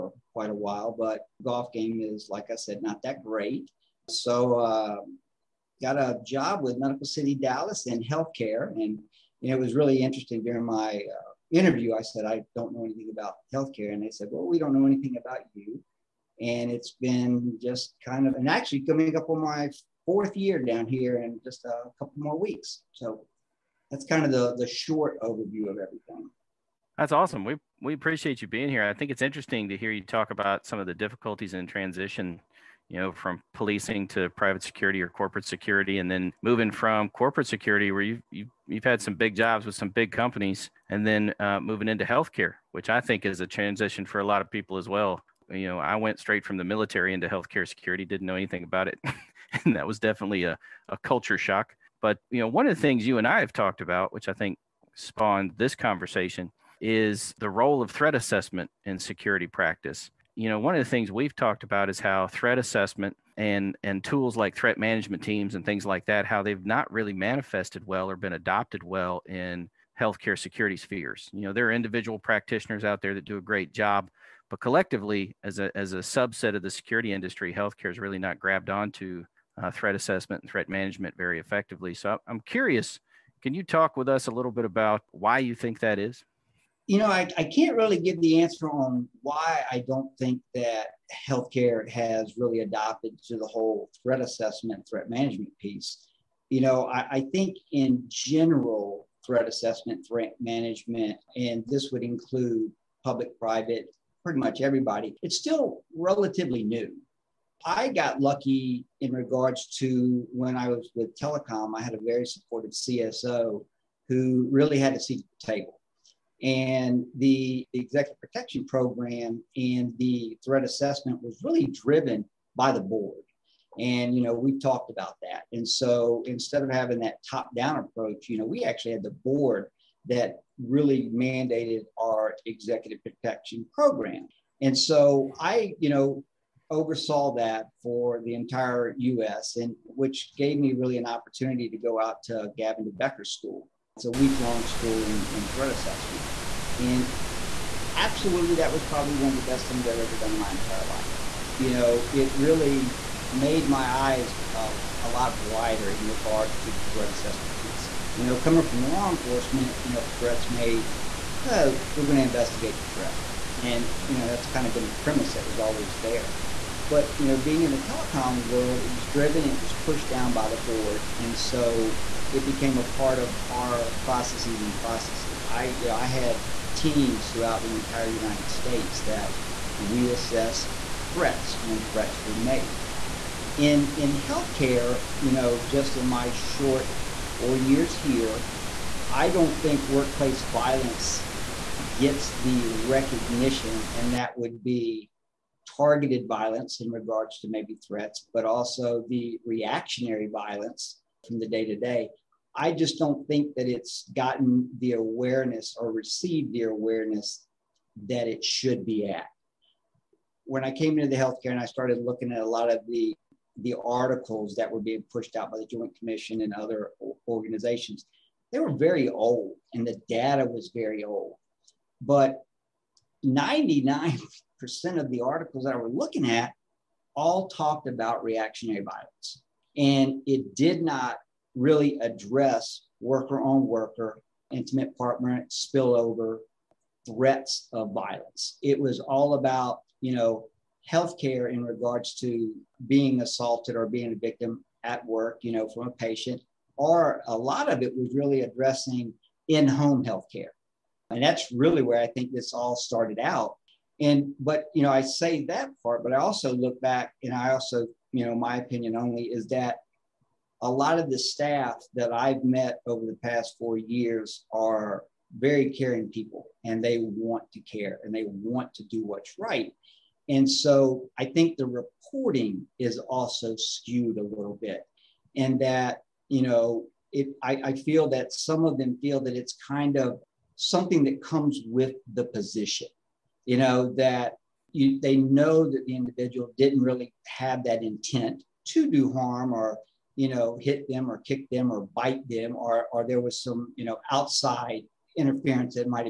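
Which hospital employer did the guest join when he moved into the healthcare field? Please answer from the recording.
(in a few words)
Medical City Dallas.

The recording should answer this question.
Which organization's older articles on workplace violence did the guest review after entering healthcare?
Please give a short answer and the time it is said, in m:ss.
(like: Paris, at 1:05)
The Joint Commission, at 3:35.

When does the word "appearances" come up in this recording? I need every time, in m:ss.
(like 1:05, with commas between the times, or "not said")
not said.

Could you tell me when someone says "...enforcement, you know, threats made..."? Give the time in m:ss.
2:39.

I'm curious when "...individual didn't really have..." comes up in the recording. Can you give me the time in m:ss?
4:45.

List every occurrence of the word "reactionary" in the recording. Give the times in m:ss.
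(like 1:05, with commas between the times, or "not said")
3:19, 3:48.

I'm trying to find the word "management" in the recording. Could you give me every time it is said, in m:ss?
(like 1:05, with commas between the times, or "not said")
1:04, 1:20, 1:35, 1:40.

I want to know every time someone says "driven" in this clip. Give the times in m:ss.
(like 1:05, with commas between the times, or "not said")
2:01, 2:49.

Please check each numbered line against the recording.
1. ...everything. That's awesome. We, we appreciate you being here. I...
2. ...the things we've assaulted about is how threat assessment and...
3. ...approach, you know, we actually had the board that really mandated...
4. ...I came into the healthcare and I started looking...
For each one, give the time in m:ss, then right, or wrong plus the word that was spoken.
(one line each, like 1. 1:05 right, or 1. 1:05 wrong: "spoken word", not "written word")
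1. 0:25 right
2. 1:00 wrong: "talked", not "assaulted"
3. 2:07 right
4. 3:30 right.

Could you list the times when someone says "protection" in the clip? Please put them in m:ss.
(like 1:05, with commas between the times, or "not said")
1:58, 2:13.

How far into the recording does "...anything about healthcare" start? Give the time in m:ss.
0:12.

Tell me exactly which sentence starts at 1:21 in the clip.
So I'm curious, can you talk with us a little bit about why you think that is?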